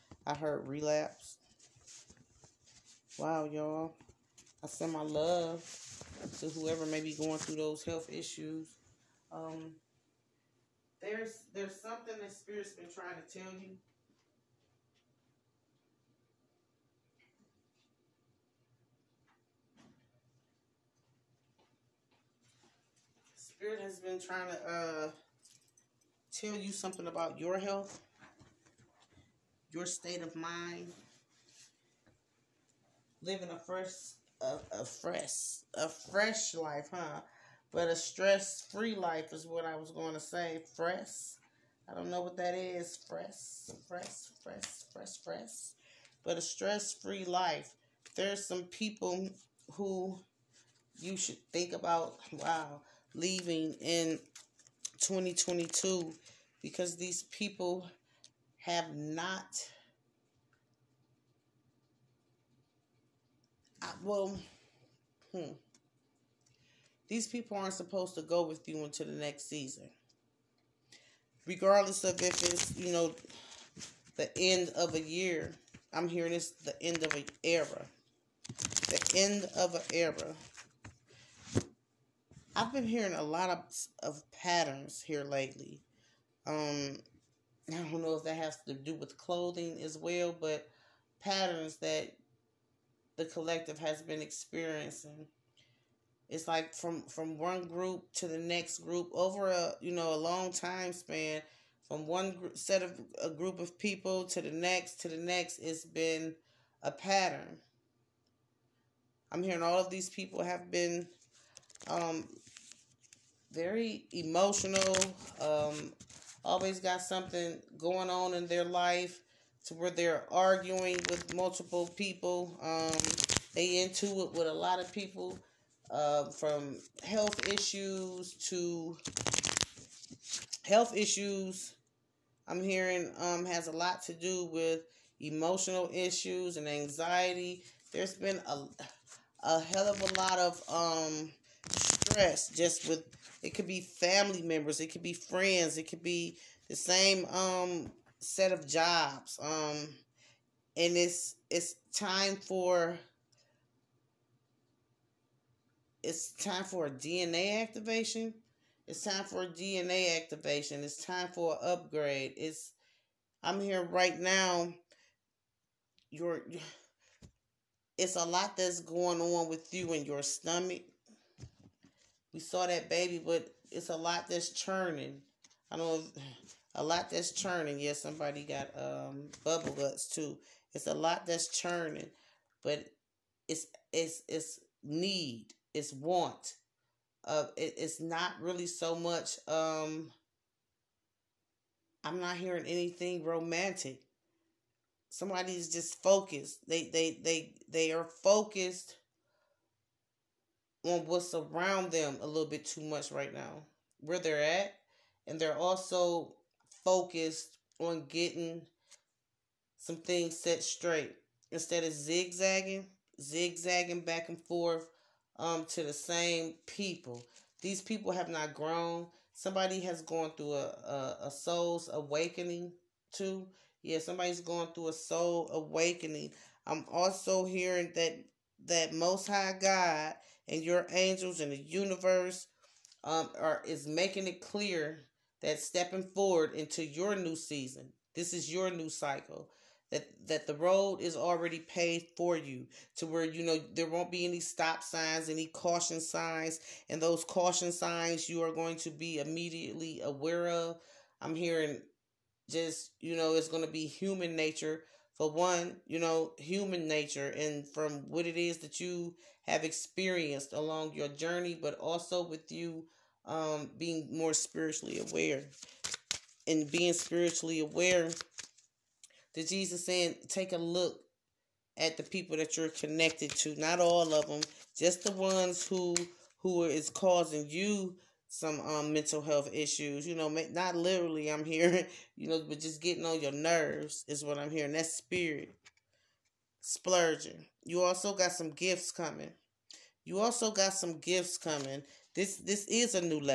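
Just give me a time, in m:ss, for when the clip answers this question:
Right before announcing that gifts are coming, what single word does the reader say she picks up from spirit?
4:46.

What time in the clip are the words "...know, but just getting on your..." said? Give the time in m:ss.
4:42.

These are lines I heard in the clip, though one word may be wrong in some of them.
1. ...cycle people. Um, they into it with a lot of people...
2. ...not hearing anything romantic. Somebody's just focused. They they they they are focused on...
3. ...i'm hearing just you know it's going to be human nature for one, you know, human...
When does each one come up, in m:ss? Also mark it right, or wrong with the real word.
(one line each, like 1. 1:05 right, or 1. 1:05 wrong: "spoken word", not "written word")
1. 2:01 wrong: "multiple", not "cycle"
2. 3:12 right
3. 4:11 right.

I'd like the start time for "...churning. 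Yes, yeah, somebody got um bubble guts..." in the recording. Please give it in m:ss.
2:57.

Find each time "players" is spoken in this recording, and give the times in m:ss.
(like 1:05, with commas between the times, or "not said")
not said.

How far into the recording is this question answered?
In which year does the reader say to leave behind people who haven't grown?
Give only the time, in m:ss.
0:54.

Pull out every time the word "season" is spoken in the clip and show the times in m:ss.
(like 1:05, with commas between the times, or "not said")
1:09, 3:57.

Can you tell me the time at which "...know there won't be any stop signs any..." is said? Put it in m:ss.
4:03.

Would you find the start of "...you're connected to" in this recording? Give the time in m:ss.
4:32.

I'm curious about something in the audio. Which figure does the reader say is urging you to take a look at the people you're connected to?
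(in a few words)
Jesus.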